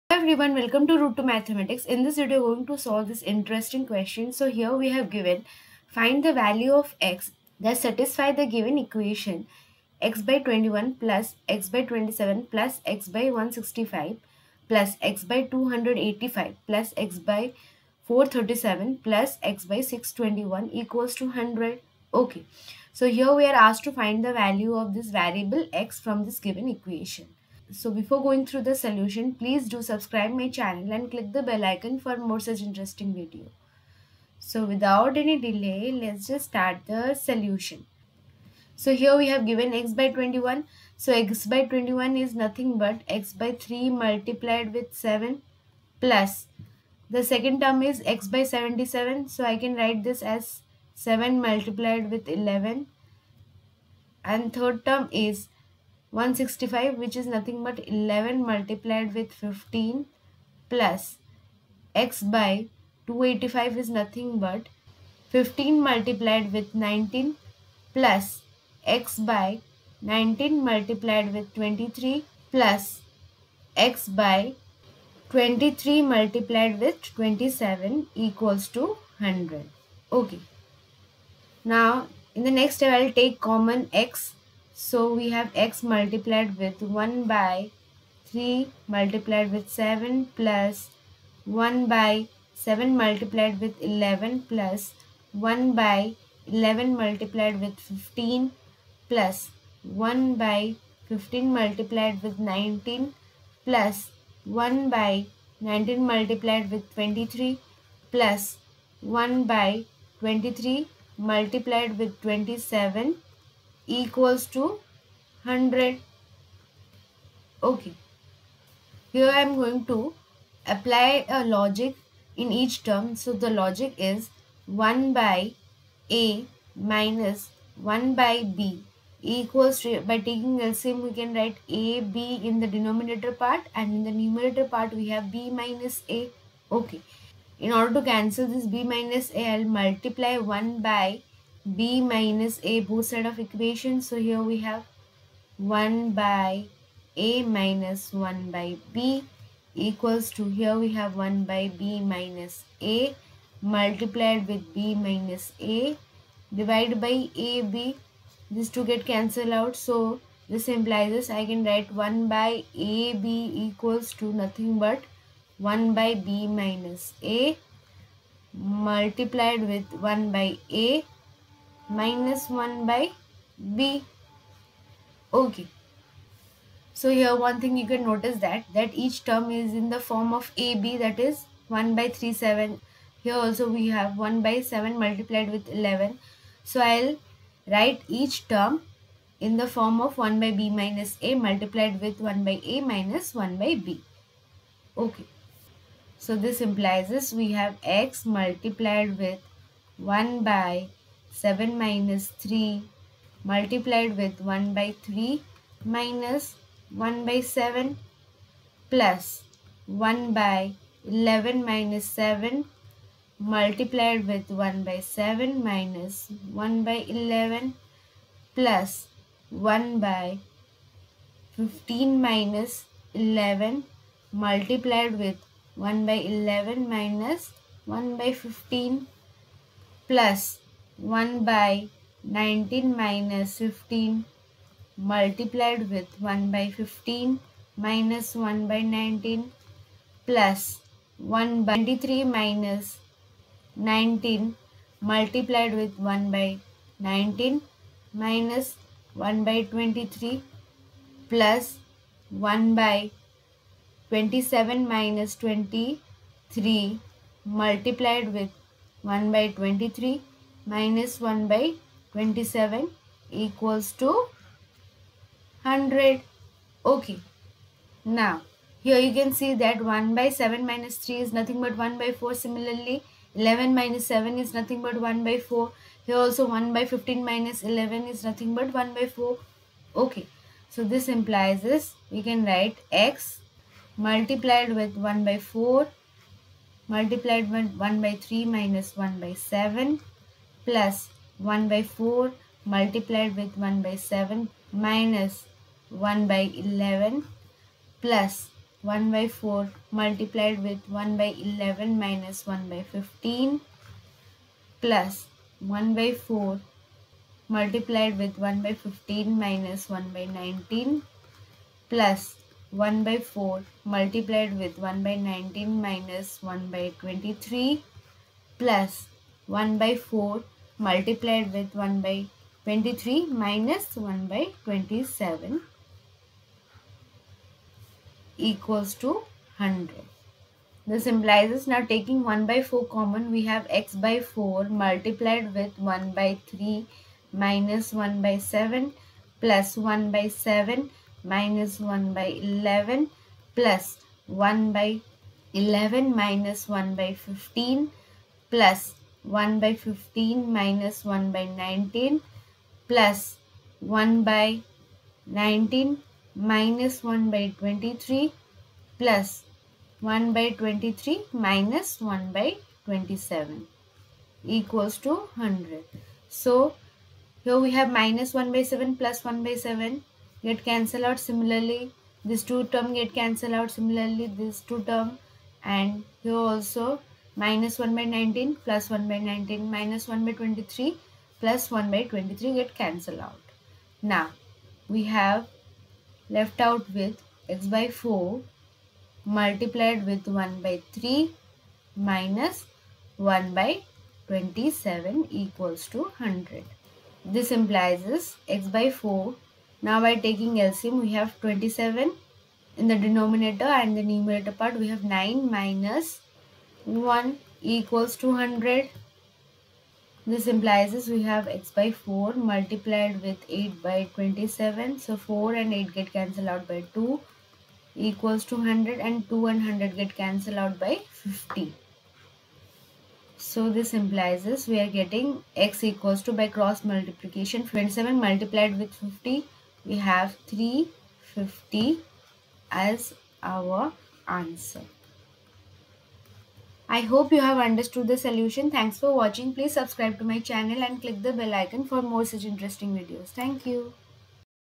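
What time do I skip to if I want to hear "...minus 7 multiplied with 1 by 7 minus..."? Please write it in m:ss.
3:31.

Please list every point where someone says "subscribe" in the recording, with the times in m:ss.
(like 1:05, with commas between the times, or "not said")
0:29, 7:19.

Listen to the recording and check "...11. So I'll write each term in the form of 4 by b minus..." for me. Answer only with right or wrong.
wrong.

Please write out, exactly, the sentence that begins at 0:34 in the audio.
So without any delay, let's just start the solution.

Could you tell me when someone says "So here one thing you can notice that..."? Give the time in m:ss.
2:56.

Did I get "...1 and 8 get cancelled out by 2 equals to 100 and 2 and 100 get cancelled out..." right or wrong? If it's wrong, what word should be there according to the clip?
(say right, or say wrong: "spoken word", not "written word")
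wrong: "4", not "1".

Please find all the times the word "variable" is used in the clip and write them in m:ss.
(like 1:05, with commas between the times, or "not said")
0:25.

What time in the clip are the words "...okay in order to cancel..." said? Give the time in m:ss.
2:16.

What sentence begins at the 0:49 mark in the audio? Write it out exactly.
So I can write this as 7 multiplied with 11.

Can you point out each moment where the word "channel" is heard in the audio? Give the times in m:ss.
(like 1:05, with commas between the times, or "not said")
0:30, 7:20.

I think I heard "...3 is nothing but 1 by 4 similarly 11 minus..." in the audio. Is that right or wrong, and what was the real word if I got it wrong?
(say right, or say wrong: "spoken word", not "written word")
right.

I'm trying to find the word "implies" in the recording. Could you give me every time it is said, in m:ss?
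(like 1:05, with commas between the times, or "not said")
2:40, 3:16, 4:41, 5:31, 6:37, 6:50, 7:03.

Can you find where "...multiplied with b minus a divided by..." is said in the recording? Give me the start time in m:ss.
2:33.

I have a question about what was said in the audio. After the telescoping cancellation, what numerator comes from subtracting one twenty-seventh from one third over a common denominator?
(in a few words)
9 minus 1.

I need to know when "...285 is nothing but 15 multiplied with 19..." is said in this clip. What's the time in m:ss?
1:03.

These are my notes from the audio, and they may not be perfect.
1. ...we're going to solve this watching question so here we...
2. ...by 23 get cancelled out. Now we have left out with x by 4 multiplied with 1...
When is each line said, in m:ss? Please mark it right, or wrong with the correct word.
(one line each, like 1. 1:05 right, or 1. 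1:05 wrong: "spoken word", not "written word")
1. 0:02 wrong: "interesting", not "watching"
2. 6:21 right.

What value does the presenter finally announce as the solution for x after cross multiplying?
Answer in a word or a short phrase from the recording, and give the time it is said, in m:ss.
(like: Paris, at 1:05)
350, at 7:10.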